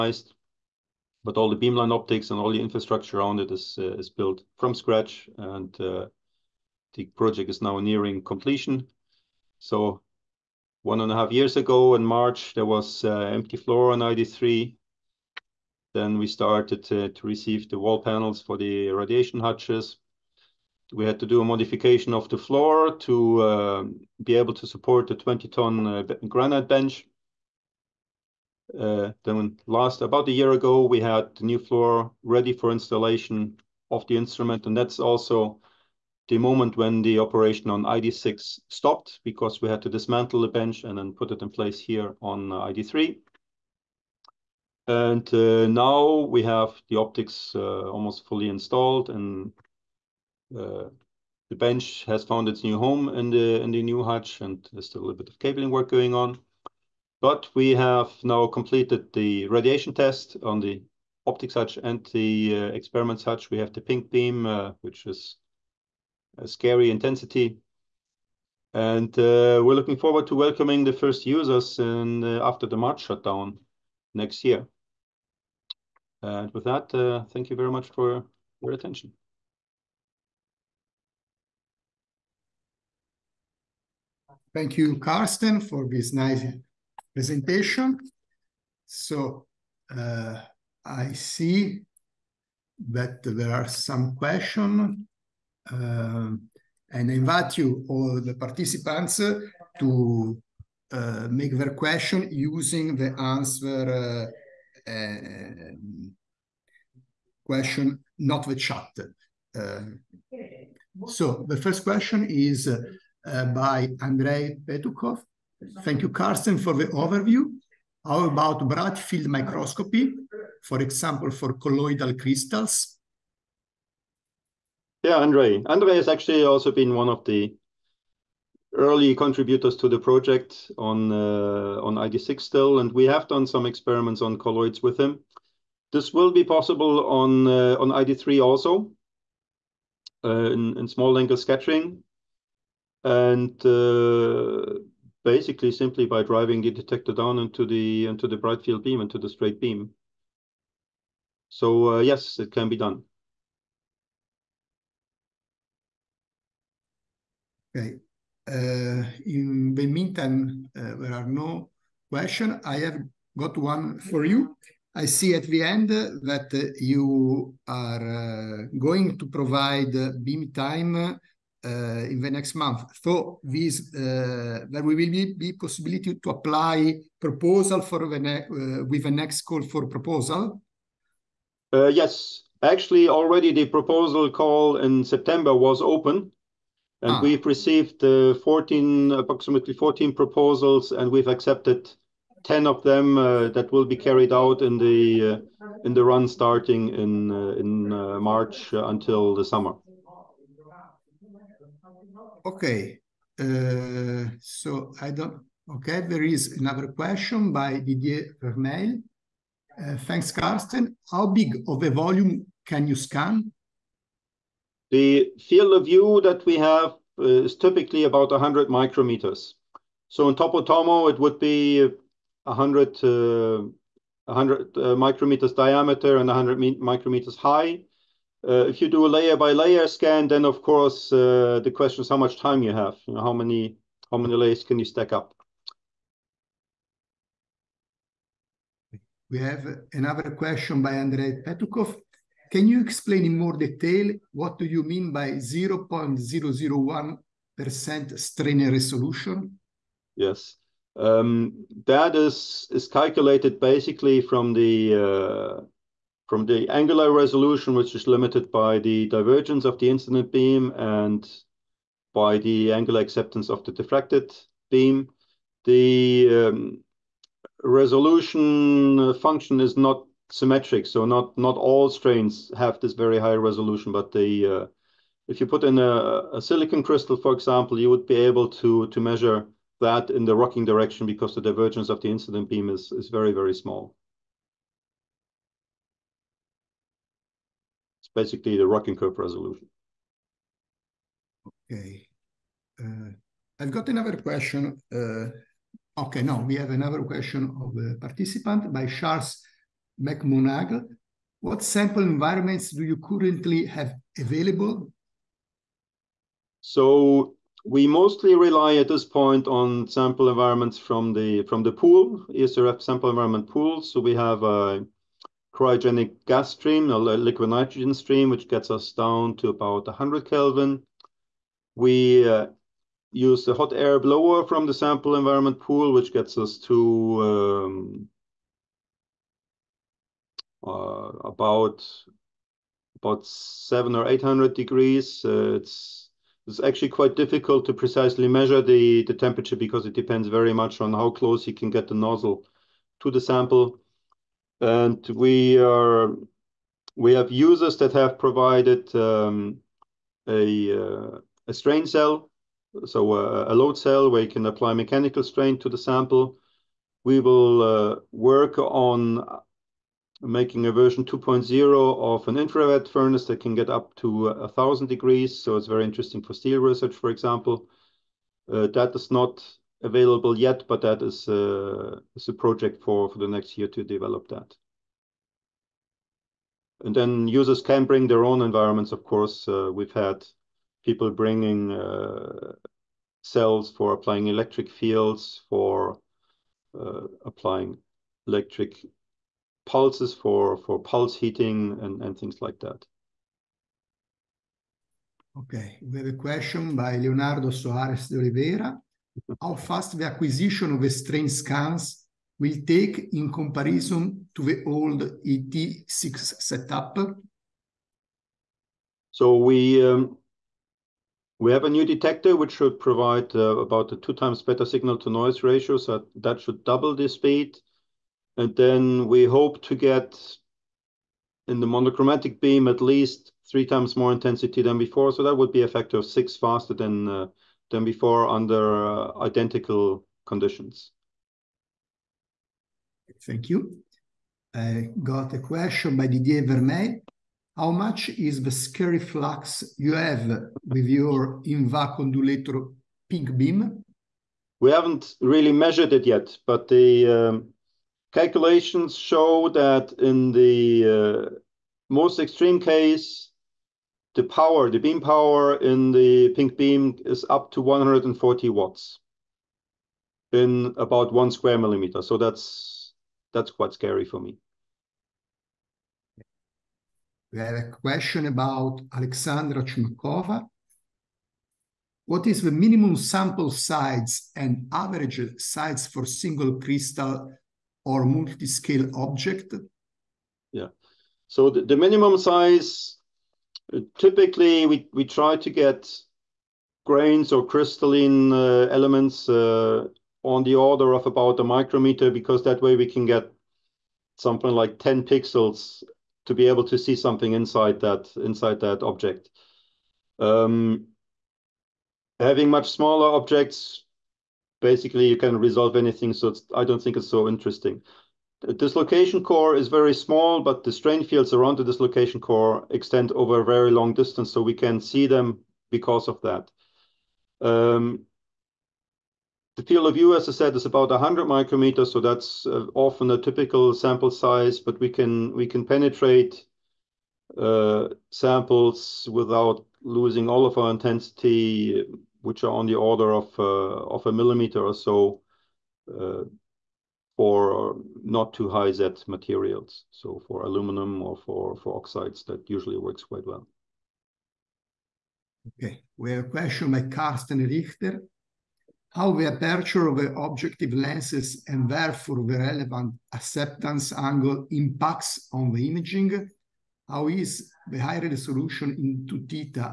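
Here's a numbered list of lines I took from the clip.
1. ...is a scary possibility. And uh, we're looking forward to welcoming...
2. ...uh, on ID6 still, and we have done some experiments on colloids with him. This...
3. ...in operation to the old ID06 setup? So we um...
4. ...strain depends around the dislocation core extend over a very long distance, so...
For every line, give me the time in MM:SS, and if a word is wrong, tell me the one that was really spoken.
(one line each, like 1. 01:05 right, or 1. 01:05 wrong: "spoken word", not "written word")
1. 01:05 wrong: "intensity", not "possibility"
2. 02:11 right
3. 06:43 wrong: "comparison", not "operation"
4. 08:30 wrong: "fields", not "depends".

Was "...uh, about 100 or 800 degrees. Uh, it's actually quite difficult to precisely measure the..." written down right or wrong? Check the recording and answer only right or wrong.
wrong.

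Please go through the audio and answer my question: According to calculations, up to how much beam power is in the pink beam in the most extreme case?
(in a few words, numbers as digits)
140 watts.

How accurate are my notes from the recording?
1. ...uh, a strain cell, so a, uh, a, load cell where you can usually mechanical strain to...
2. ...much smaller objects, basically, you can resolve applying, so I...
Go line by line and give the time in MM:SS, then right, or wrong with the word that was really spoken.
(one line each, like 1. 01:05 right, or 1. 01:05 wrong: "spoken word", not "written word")
1. 05:50 wrong: "apply", not "usually"
2. 08:22 wrong: "anything", not "applying".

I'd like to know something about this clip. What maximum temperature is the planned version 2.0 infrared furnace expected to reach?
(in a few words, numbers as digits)
1000 degrees.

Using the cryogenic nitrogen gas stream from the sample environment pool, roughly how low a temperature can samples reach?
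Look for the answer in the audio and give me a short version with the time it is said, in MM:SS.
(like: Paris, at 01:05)
100 Kelvin, at 05:19.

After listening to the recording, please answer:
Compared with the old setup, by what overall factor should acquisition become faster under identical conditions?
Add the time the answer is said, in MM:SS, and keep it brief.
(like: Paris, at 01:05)
6, at 07:05.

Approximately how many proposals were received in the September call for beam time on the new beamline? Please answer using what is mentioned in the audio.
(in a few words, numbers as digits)
14.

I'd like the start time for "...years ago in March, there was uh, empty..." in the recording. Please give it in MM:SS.
00:11.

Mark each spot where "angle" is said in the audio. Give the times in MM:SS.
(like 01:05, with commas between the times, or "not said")
02:21, 09:13.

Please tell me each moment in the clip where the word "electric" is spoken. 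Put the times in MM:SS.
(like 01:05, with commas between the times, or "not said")
06:24, 06:28.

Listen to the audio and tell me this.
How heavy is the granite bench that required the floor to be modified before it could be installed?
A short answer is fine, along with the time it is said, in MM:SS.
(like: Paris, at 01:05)
20 tons, at 00:25.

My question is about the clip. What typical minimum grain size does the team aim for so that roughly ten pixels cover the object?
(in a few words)
1 micrometer.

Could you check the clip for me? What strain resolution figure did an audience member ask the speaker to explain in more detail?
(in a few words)
0.001%.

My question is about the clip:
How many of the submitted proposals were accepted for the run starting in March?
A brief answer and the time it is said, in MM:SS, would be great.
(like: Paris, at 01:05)
10, at 03:12.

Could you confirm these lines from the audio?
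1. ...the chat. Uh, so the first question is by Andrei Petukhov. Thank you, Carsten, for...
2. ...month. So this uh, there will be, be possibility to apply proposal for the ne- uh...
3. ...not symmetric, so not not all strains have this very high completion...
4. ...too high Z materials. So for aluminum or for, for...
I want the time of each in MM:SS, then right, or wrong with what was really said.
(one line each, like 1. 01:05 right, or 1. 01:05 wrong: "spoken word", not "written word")
1. 01:48 right
2. 02:52 right
3. 04:29 wrong: "resolution", not "completion"
4. 08:58 right.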